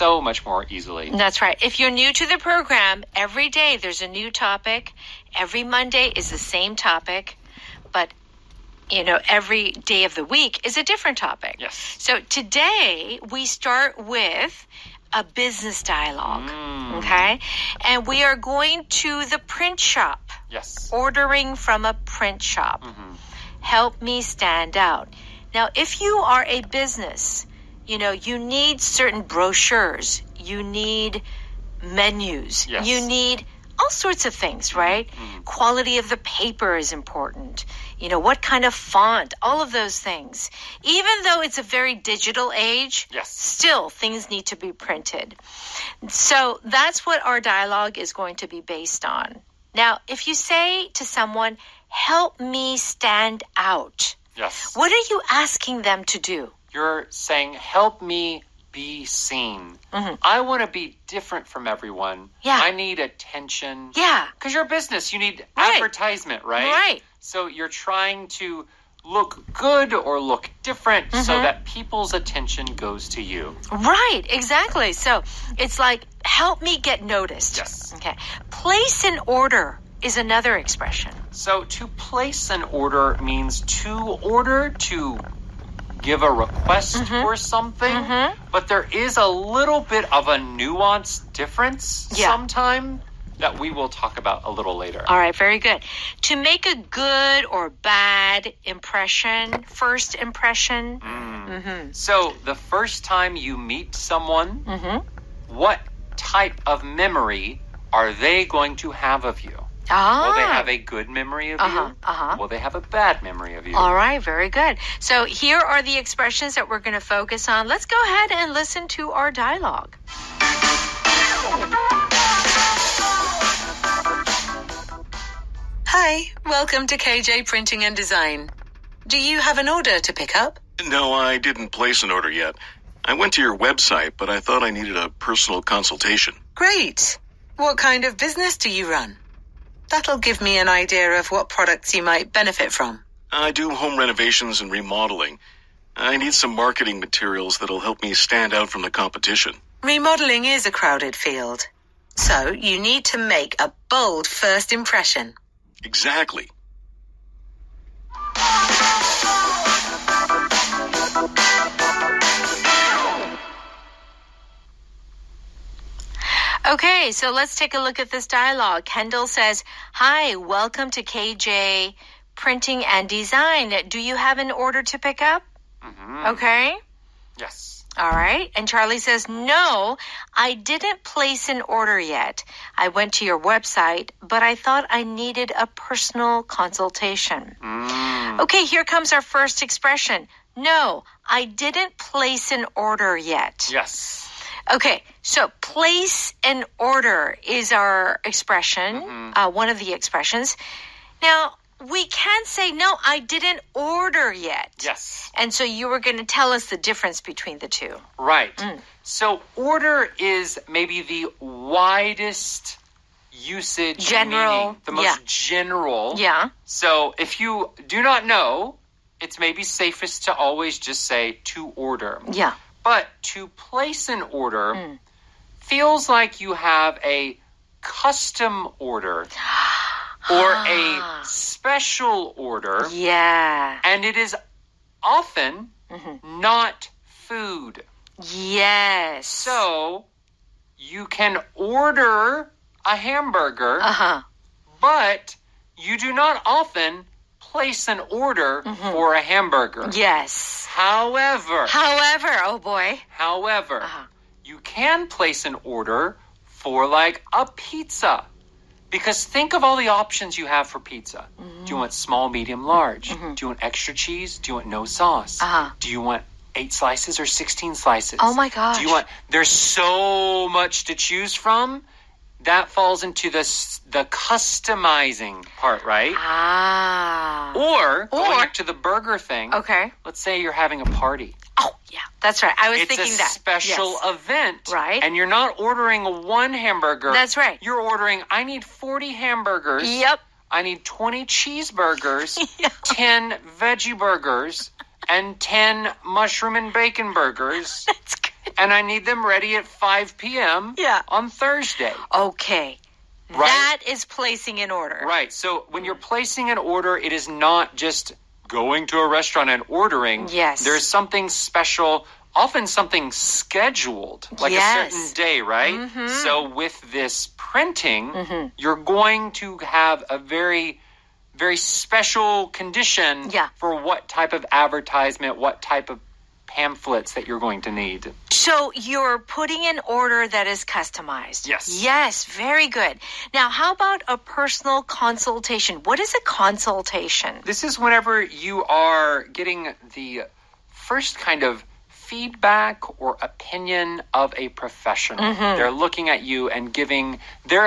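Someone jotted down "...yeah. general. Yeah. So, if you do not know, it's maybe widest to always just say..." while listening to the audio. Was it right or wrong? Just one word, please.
wrong.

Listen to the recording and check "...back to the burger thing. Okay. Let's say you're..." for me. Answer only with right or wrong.
right.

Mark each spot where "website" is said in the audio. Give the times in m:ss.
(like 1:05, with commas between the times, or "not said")
2:13, 3:03.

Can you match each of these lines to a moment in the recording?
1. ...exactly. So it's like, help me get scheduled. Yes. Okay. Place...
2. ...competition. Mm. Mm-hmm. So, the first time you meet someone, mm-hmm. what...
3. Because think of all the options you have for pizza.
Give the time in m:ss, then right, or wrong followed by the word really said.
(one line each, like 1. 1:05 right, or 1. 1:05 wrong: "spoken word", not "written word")
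1. 1:14 wrong: "noticed", not "scheduled"
2. 1:40 wrong: "impression", not "competition"
3. 4:18 right.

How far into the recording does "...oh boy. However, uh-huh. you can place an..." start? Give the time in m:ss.
4:12.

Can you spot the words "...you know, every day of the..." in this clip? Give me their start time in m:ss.
0:08.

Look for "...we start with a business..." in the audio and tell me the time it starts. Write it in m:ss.
0:13.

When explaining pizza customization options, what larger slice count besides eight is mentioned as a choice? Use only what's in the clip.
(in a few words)
16.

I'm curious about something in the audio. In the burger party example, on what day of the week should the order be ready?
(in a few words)
Thursday.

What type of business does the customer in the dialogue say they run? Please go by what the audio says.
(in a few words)
Home renovations and remodeling.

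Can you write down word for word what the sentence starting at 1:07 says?
So you're trying to look good or look different mm-hmm.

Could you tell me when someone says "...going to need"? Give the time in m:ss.
5:27.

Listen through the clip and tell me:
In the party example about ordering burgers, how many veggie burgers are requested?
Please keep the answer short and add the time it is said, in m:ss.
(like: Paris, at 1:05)
10, at 4:52.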